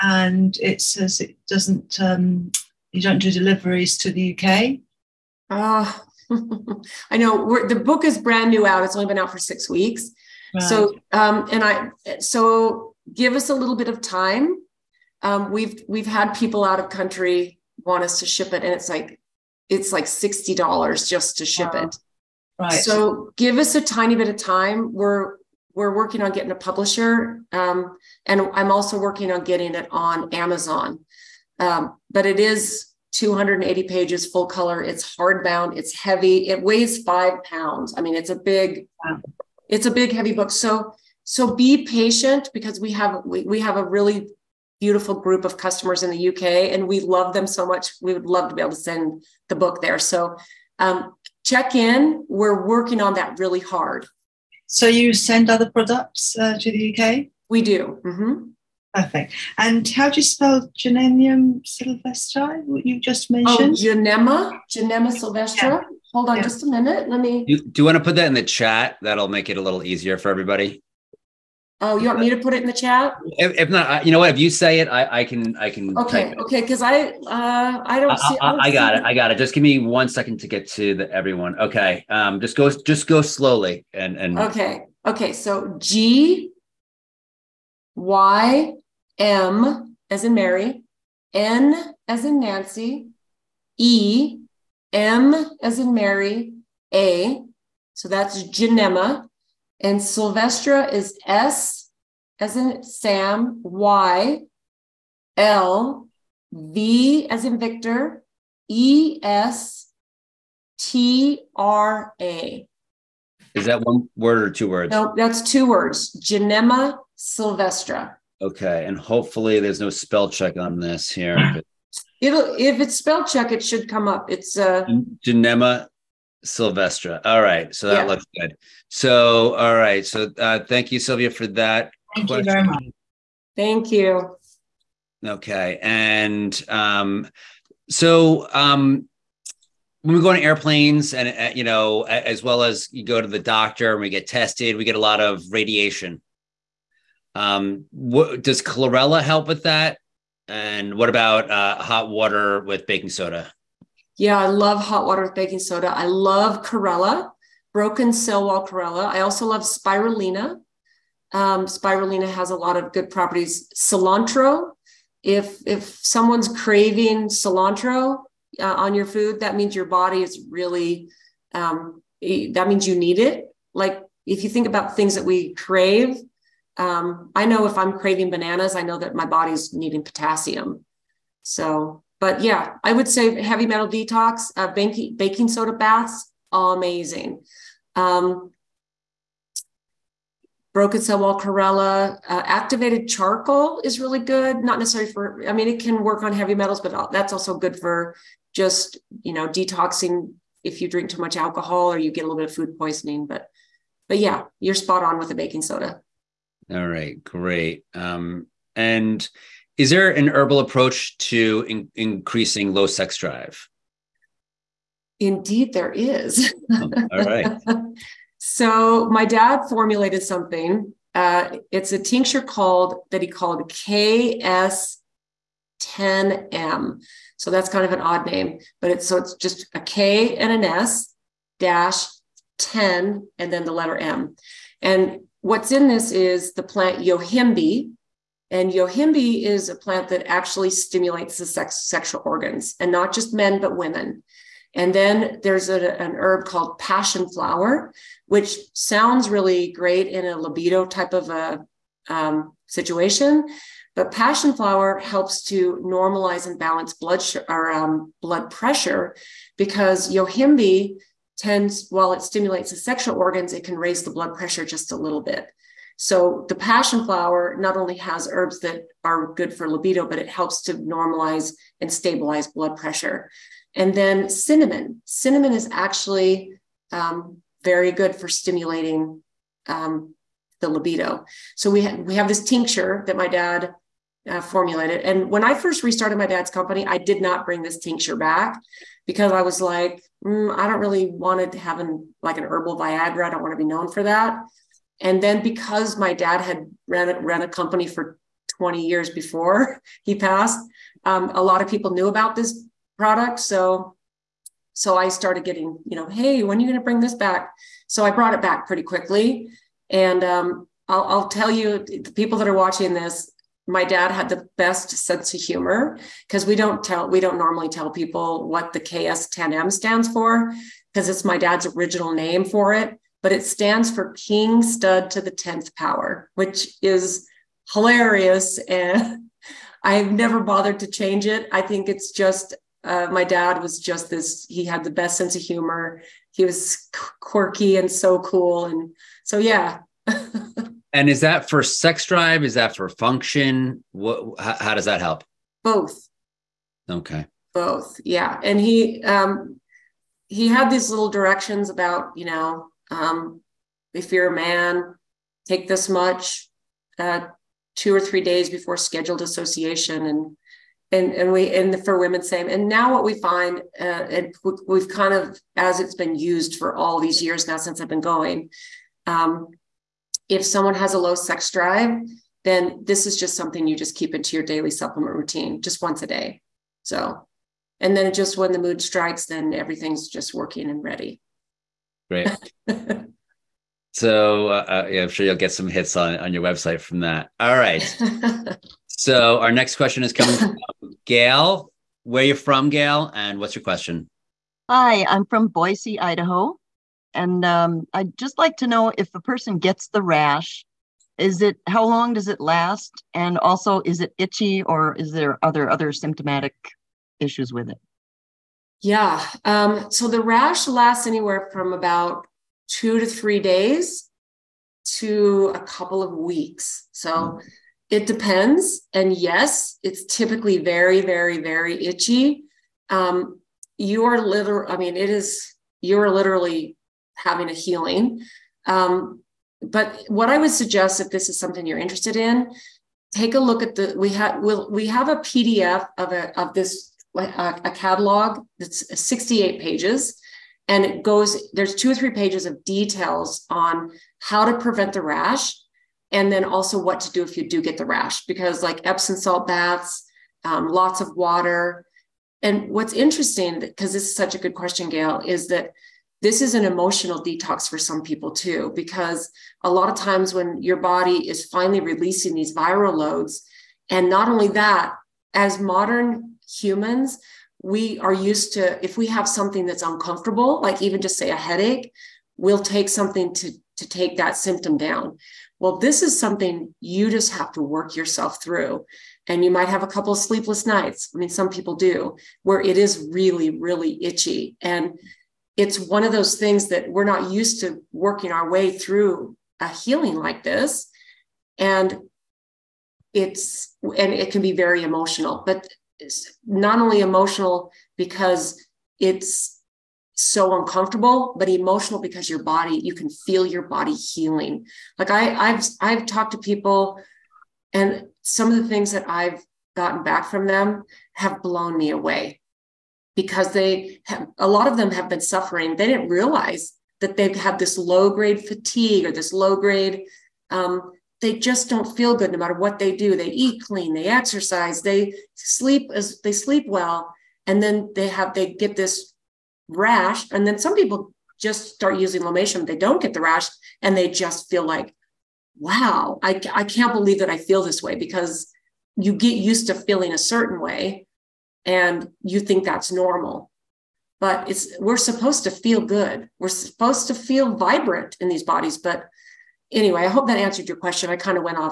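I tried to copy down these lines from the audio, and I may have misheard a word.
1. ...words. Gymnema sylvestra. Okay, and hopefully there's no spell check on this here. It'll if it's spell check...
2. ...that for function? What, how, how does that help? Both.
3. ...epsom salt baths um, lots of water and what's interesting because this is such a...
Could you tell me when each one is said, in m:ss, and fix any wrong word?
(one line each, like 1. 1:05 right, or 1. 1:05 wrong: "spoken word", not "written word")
1. 1:55 right
2. 5:42 right
3. 7:28 right.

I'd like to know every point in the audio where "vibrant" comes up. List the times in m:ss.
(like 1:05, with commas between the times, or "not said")
9:07.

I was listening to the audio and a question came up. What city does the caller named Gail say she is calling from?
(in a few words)
Boise, Idaho.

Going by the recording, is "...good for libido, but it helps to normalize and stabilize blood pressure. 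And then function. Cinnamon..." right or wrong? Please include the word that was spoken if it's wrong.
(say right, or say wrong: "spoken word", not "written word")
wrong: "cinnamon", not "function".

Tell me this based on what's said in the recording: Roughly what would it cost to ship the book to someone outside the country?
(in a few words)
$60.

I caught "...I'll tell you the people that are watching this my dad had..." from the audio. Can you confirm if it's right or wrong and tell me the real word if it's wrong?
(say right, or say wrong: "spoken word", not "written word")
right.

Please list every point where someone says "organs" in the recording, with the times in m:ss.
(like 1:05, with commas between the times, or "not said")
4:02, 4:23.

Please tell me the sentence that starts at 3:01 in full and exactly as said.
So but yeah, I would say heavy metal detox, uh, baking, baking soda baths, amazing.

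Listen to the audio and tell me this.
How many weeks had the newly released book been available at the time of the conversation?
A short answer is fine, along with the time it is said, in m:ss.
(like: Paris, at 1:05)
6, at 0:09.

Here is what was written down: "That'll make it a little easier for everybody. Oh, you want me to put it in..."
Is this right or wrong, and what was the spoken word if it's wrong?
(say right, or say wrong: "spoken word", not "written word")
right.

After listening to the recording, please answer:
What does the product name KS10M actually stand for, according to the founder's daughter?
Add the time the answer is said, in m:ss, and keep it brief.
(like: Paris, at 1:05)
King Stud to the 10th power, at 5:24.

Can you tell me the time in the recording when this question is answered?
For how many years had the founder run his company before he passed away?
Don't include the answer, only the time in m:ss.
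4:58.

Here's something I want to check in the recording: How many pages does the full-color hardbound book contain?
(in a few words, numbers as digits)
280.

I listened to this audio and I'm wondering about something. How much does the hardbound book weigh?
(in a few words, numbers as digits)
5 pounds.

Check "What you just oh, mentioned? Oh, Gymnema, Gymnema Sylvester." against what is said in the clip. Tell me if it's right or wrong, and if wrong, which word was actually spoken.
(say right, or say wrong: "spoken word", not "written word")
right.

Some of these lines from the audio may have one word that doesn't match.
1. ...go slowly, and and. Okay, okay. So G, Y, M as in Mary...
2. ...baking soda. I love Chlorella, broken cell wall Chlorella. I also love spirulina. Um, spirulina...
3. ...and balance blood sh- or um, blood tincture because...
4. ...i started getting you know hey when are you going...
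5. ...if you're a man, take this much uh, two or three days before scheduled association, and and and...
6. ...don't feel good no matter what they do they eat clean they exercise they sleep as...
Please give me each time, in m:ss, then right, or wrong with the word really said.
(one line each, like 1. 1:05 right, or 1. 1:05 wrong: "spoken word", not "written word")
1. 1:23 right
2. 2:35 right
3. 4:16 wrong: "pressure", not "tincture"
4. 5:04 right
5. 5:53 right
6. 8:41 right.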